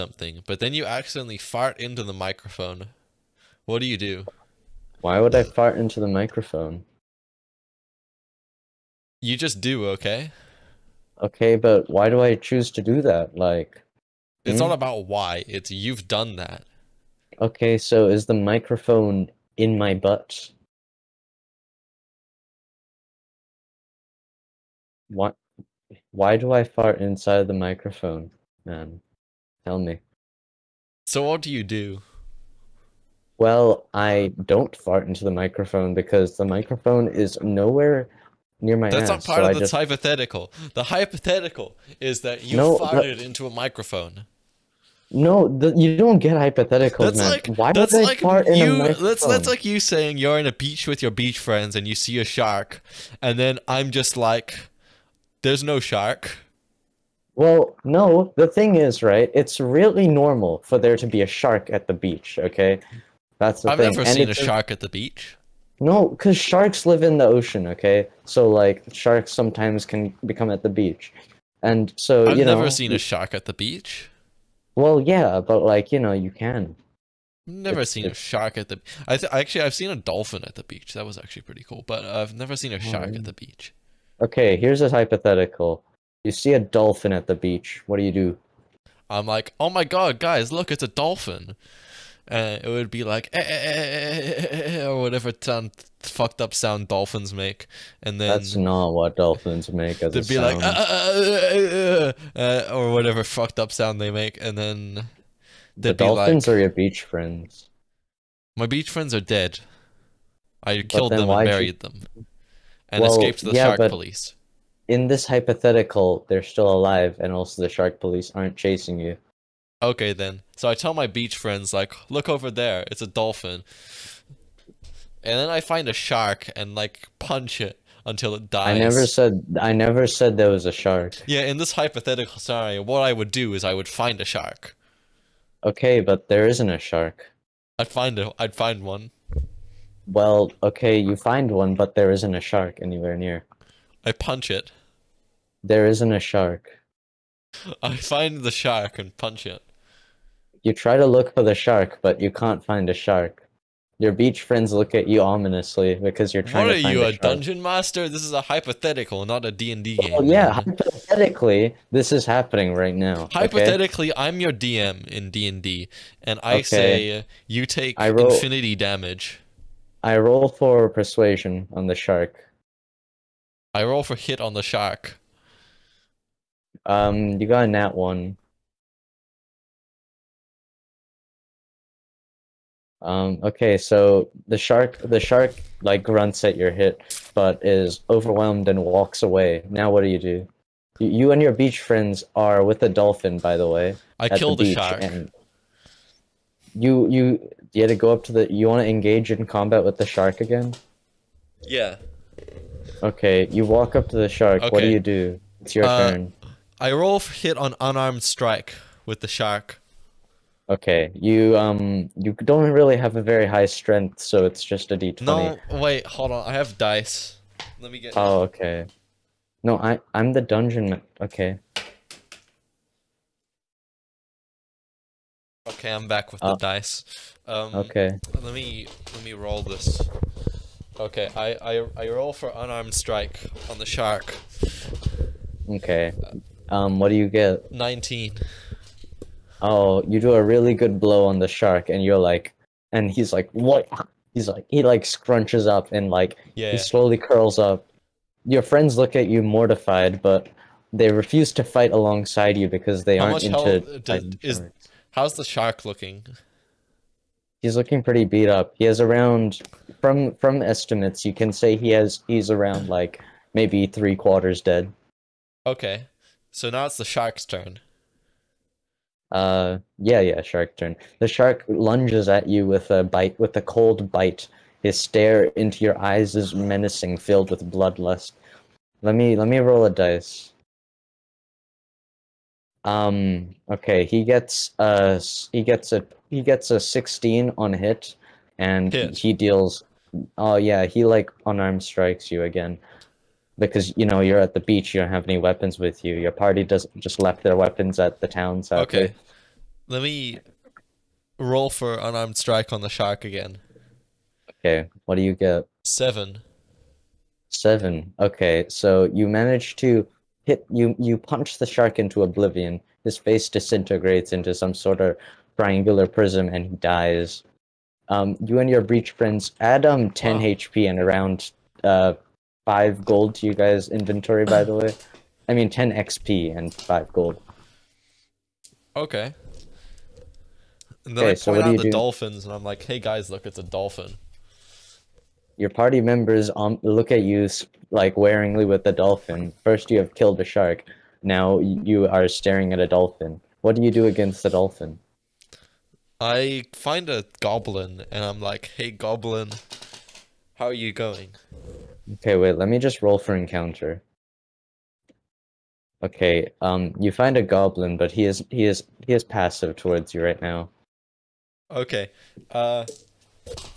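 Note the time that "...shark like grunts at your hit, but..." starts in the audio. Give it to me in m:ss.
3:05.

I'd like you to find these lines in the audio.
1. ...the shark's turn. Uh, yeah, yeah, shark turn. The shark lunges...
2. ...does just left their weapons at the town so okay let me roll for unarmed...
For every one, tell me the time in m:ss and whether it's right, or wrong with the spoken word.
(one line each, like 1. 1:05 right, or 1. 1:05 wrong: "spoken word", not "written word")
1. 4:26 right
2. 4:56 right.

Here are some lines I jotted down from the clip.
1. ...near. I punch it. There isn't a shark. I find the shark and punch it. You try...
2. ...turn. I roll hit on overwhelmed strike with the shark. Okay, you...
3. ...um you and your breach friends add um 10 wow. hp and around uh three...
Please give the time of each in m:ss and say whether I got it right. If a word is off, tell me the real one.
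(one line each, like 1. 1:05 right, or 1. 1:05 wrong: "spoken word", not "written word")
1. 2:23 right
2. 3:26 wrong: "unarmed", not "overwhelmed"
3. 5:18 wrong: "five", not "three".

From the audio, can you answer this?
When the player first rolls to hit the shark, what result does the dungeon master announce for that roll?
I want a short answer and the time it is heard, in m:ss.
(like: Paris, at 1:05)
nat 1, at 2:57.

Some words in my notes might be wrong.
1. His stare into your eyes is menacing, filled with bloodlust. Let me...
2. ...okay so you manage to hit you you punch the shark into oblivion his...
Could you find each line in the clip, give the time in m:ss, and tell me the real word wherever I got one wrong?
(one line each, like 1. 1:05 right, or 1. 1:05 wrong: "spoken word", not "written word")
1. 4:34 right
2. 5:08 right.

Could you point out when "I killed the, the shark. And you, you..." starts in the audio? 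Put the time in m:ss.
3:14.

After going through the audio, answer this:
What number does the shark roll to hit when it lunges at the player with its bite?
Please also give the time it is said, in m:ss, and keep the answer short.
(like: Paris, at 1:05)
16, at 4:46.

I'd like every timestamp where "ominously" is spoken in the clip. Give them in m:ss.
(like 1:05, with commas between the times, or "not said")
2:35.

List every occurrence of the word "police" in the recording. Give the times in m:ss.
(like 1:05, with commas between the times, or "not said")
1:53, 1:58.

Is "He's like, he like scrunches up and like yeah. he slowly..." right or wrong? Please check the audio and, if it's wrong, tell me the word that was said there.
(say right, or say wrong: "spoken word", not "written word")
right.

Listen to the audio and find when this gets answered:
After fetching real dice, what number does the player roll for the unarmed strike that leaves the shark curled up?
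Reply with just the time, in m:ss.
3:57.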